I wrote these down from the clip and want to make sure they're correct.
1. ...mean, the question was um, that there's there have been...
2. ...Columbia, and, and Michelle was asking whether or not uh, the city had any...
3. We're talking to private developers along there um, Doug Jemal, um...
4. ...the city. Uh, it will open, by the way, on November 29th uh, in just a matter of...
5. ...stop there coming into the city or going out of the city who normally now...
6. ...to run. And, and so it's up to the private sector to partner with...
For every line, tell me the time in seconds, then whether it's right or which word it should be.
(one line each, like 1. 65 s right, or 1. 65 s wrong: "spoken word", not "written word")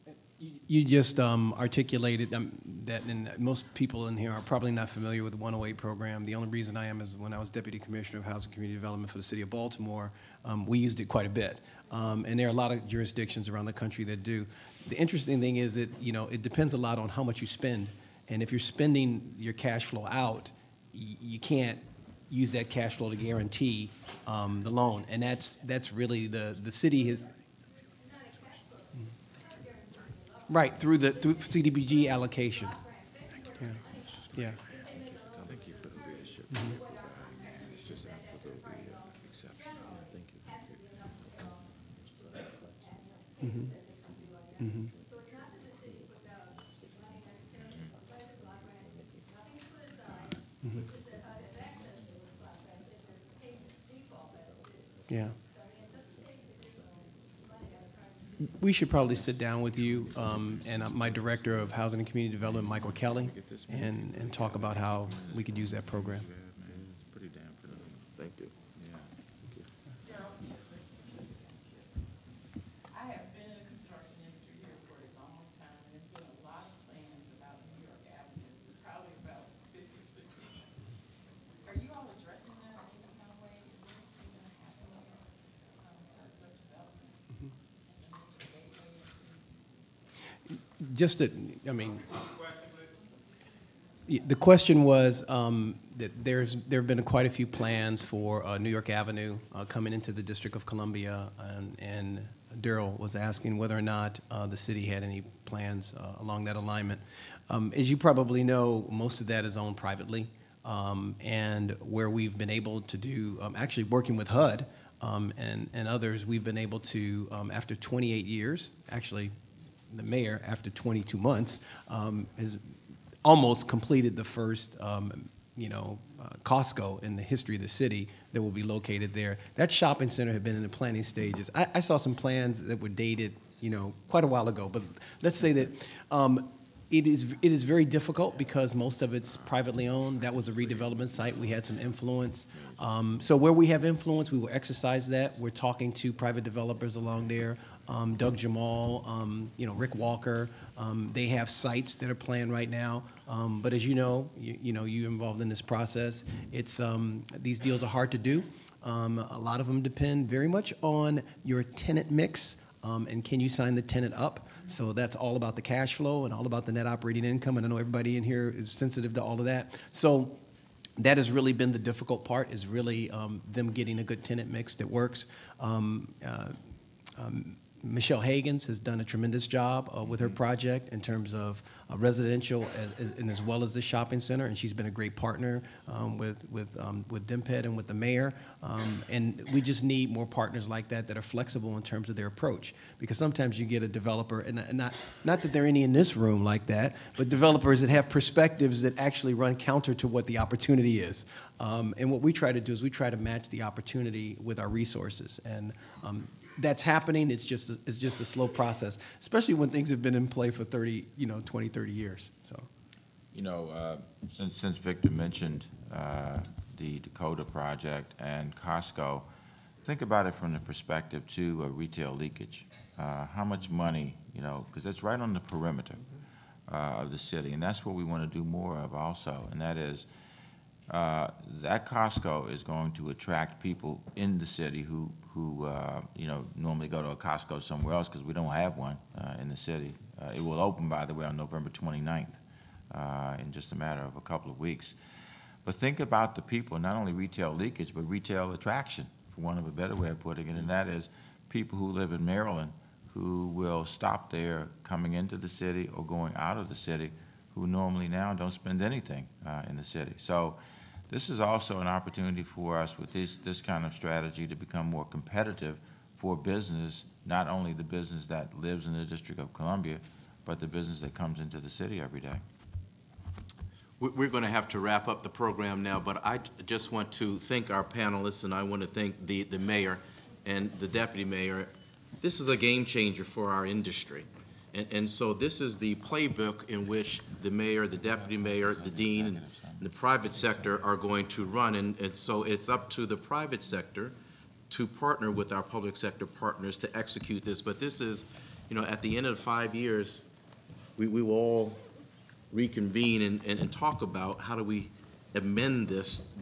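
1. 91 s right
2. 100 s wrong: "Daryl", not "Michelle"
3. 145 s right
4. 239 s right
5. 253 s right
6. 291 s right.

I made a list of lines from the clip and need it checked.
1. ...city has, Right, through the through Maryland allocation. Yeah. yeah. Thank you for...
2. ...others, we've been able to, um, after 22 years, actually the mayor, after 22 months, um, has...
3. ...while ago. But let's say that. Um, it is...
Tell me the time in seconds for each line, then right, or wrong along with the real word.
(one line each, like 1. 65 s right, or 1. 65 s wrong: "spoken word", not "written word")
1. 26 s wrong: "CDBG", not "Maryland"
2. 115 s wrong: "28", not "22"
3. 134 s right.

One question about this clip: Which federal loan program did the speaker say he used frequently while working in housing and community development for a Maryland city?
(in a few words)
108 program.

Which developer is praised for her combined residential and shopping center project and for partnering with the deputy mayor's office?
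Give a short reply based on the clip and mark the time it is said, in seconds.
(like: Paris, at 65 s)
Michelle Hagans, at 177 s.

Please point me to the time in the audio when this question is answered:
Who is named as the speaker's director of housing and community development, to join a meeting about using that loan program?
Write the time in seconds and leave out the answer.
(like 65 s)
62 s.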